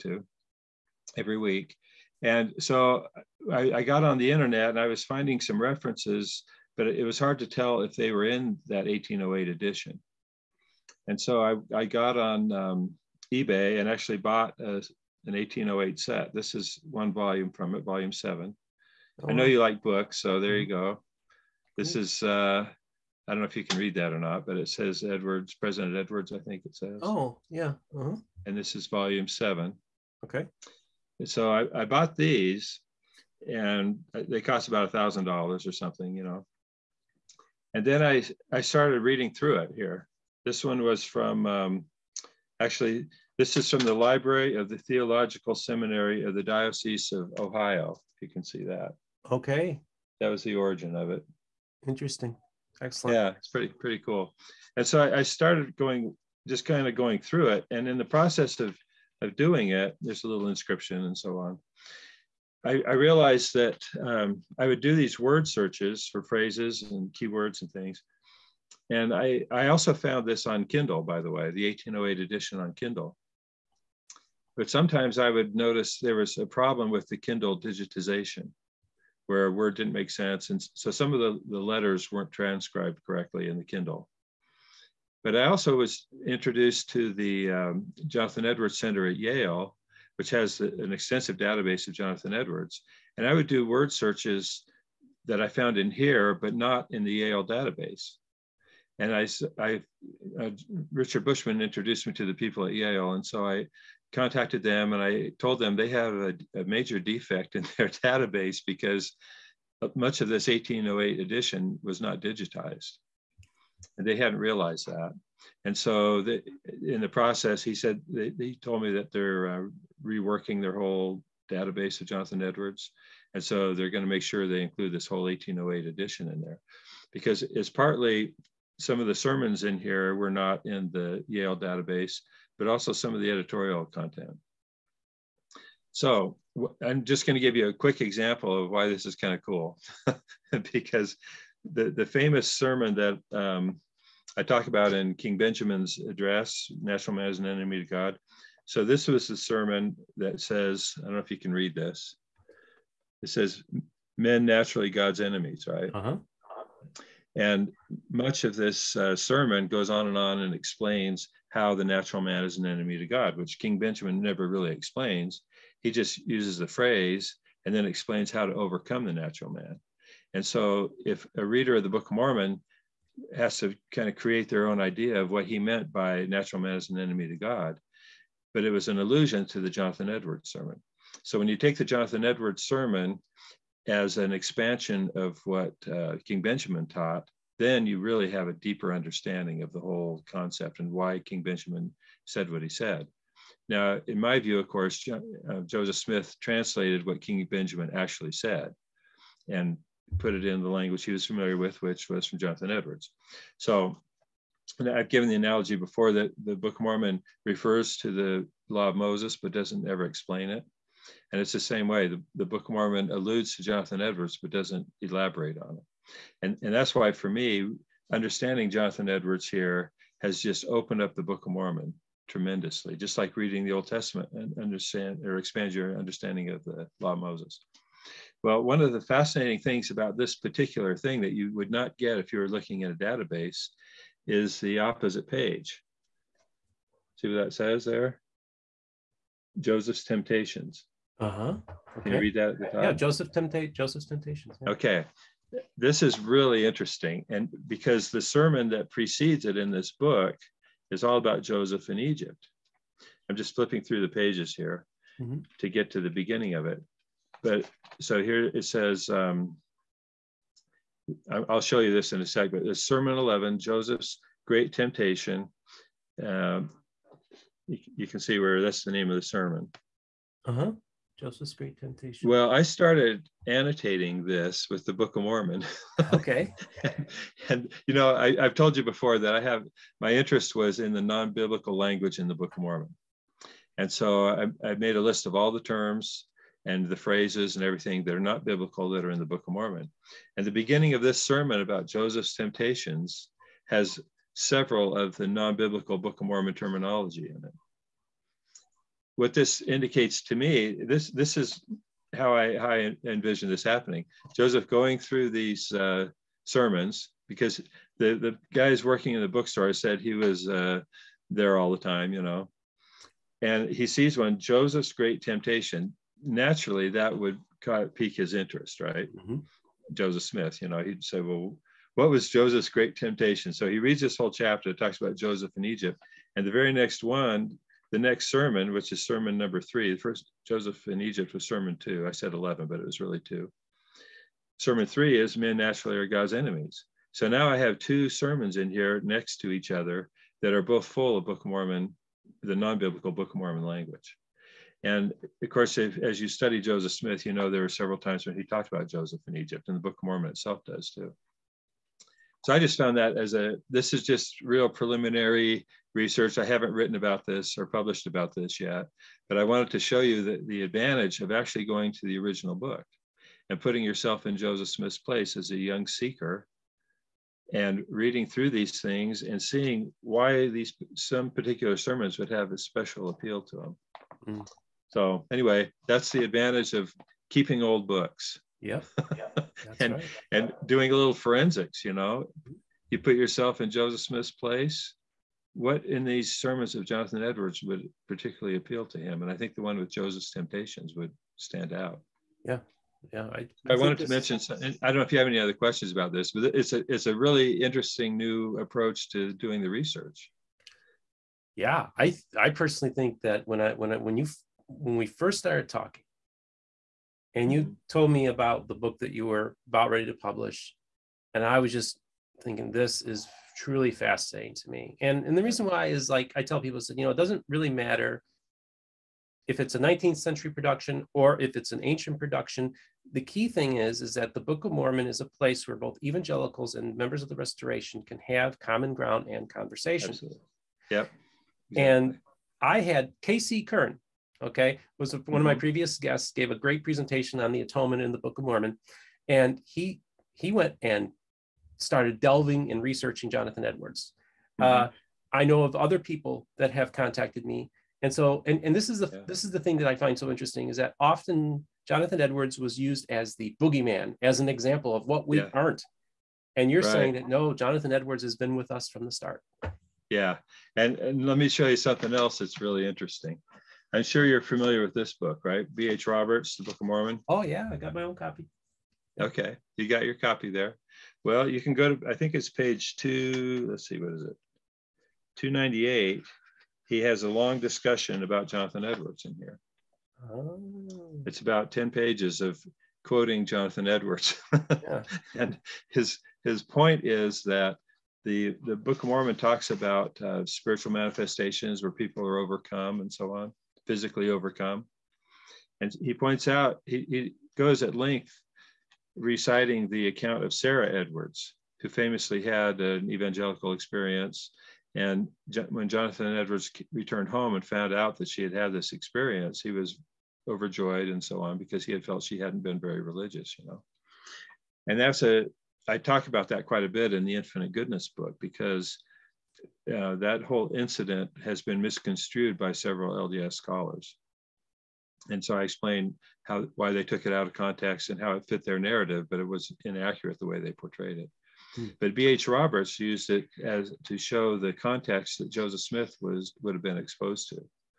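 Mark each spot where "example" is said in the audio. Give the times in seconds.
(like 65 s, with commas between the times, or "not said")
137 s, 454 s.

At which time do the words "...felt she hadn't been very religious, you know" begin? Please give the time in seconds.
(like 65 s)
512 s.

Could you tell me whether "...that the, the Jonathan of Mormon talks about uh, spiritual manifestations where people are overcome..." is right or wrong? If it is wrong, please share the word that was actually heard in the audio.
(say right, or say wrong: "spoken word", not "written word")
wrong: "Book", not "Jonathan".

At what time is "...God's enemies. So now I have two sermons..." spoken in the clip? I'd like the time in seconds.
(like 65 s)
336 s.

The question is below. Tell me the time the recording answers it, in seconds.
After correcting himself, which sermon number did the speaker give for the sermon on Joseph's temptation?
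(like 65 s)
331 s.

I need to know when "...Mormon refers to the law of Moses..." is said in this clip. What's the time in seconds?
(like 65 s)
206 s.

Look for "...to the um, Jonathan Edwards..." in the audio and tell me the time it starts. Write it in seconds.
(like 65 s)
86 s.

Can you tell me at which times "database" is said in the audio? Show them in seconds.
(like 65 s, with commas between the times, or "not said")
91 s, 97 s, 107 s, 121 s, 131 s, 232 s.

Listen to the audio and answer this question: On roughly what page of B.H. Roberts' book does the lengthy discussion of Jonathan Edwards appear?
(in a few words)
298.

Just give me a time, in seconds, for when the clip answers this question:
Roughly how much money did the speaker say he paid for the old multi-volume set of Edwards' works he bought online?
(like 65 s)
34 s.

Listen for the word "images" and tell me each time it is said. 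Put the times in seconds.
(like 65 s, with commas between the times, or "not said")
not said.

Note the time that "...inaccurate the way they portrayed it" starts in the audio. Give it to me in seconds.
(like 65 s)
529 s.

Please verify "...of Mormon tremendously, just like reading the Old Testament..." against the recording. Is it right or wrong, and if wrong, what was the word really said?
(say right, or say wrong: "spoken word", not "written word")
right.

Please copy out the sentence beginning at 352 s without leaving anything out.
So I just found that as a, this is just real preliminary research.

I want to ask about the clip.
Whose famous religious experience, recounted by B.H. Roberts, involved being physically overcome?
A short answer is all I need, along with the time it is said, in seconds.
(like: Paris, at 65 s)
Sarah Edwards, at 500 s.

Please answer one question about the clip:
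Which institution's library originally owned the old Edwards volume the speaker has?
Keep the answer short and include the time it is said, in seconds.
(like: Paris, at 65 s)
Theological Seminary of the Diocese of Ohio, at 44 s.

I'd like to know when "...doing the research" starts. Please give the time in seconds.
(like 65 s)
399 s.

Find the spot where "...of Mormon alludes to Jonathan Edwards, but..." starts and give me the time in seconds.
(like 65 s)
212 s.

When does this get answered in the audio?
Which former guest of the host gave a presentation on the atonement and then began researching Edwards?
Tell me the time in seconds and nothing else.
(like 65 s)
433 s.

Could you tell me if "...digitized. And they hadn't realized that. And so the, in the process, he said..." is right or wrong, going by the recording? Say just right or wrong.
right.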